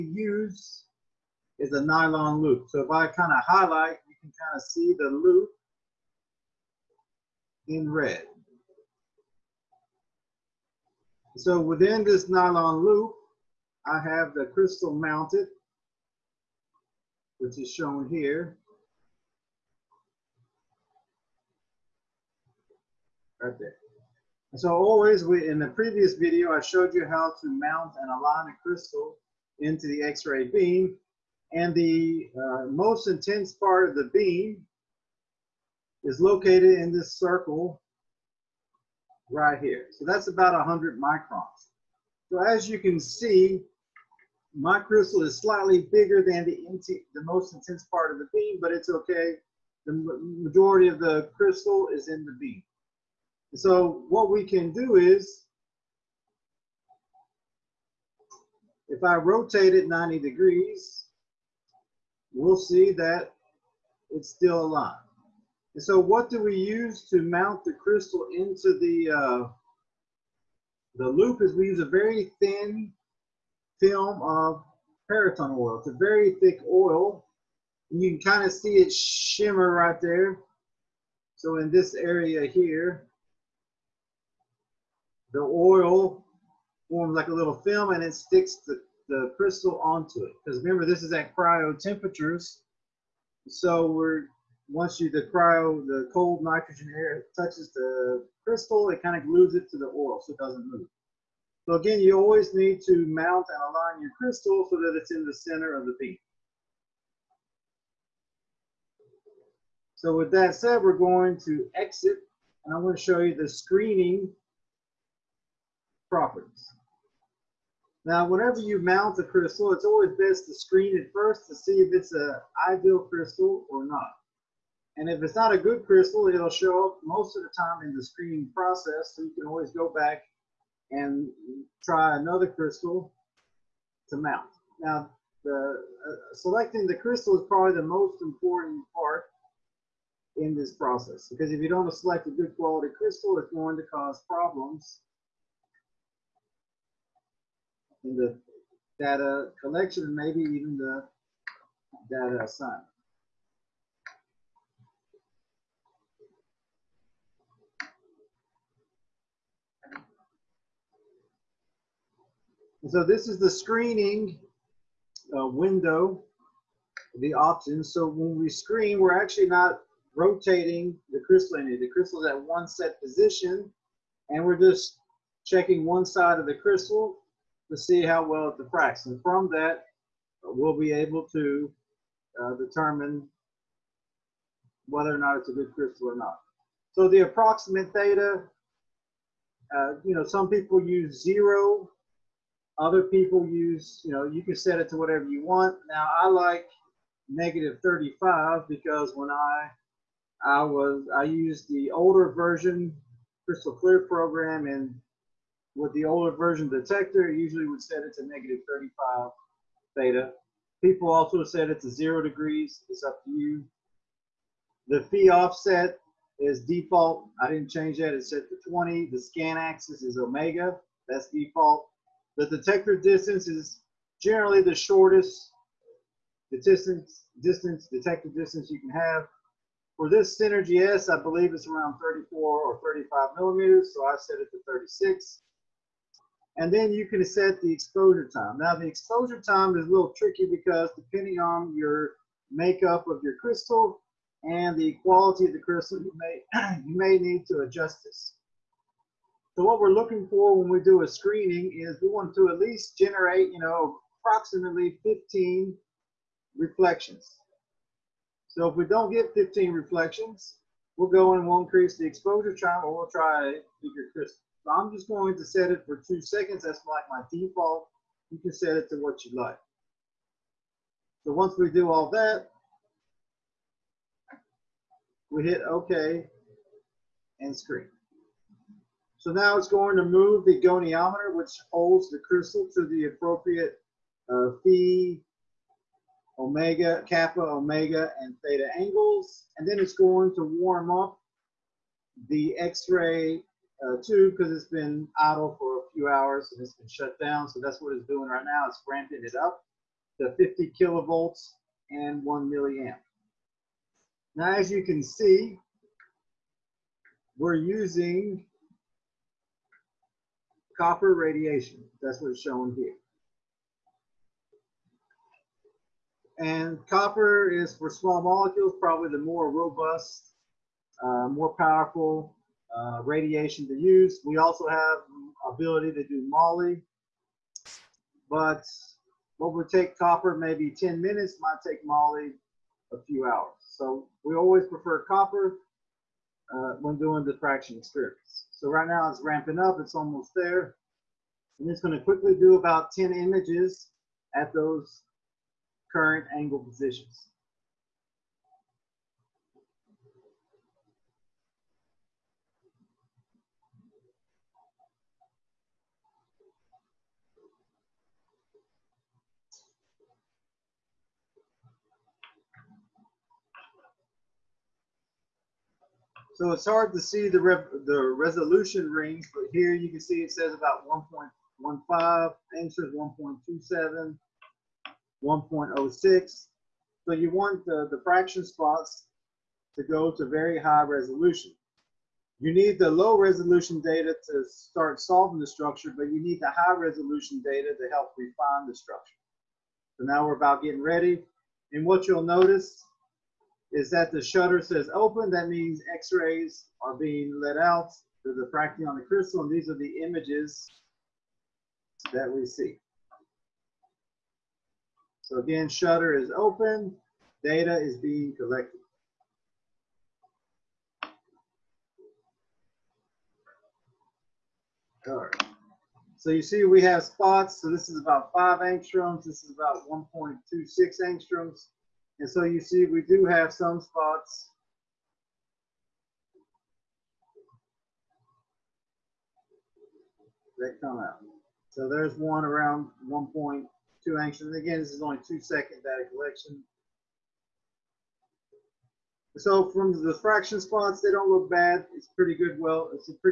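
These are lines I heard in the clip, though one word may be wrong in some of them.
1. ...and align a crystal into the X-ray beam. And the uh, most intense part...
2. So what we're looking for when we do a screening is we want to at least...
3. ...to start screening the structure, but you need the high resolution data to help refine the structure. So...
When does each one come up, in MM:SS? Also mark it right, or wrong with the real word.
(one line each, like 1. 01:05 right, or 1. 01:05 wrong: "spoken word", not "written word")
1. 00:28 right
2. 04:09 right
3. 06:24 wrong: "solving", not "screening".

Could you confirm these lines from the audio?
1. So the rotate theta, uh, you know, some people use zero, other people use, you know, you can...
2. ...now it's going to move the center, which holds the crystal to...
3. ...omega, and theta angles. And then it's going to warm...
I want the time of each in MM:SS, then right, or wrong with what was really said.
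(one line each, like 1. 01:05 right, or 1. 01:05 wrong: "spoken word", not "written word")
1. 03:06 wrong: "approximate", not "rotate"
2. 04:39 wrong: "goniometer", not "center"
3. 04:47 right.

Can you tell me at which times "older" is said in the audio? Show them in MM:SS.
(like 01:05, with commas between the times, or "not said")
03:21, 03:26.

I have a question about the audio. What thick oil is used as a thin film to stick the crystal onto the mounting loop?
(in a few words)
Paratone oil.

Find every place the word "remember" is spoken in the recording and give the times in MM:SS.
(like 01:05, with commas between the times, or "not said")
01:30.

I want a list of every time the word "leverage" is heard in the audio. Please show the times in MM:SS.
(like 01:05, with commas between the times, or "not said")
not said.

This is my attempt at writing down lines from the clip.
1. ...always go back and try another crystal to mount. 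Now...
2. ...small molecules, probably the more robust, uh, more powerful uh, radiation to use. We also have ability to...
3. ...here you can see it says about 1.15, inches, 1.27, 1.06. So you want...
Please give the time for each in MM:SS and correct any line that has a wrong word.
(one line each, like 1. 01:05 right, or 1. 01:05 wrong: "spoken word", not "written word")
1. 02:09 right
2. 05:17 right
3. 06:09 right.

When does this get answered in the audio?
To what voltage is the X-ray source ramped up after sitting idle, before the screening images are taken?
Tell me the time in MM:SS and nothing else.
05:00.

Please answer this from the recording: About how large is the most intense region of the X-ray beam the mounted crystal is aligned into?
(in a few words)
100 microns.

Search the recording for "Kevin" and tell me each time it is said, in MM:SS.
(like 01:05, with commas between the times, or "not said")
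not said.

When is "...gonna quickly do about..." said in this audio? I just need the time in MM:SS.
05:41.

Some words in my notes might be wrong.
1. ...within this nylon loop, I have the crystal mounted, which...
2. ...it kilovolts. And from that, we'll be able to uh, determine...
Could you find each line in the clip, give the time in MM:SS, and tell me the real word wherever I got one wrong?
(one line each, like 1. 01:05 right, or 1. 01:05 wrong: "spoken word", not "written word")
1. 00:11 right
2. 02:58 wrong: "diffracts", not "kilovolts".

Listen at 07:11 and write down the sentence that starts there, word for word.
So there's one around 1.2 And Again, this is only two second data collection.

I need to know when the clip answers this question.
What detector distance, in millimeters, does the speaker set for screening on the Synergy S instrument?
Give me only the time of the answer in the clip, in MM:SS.
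03:54.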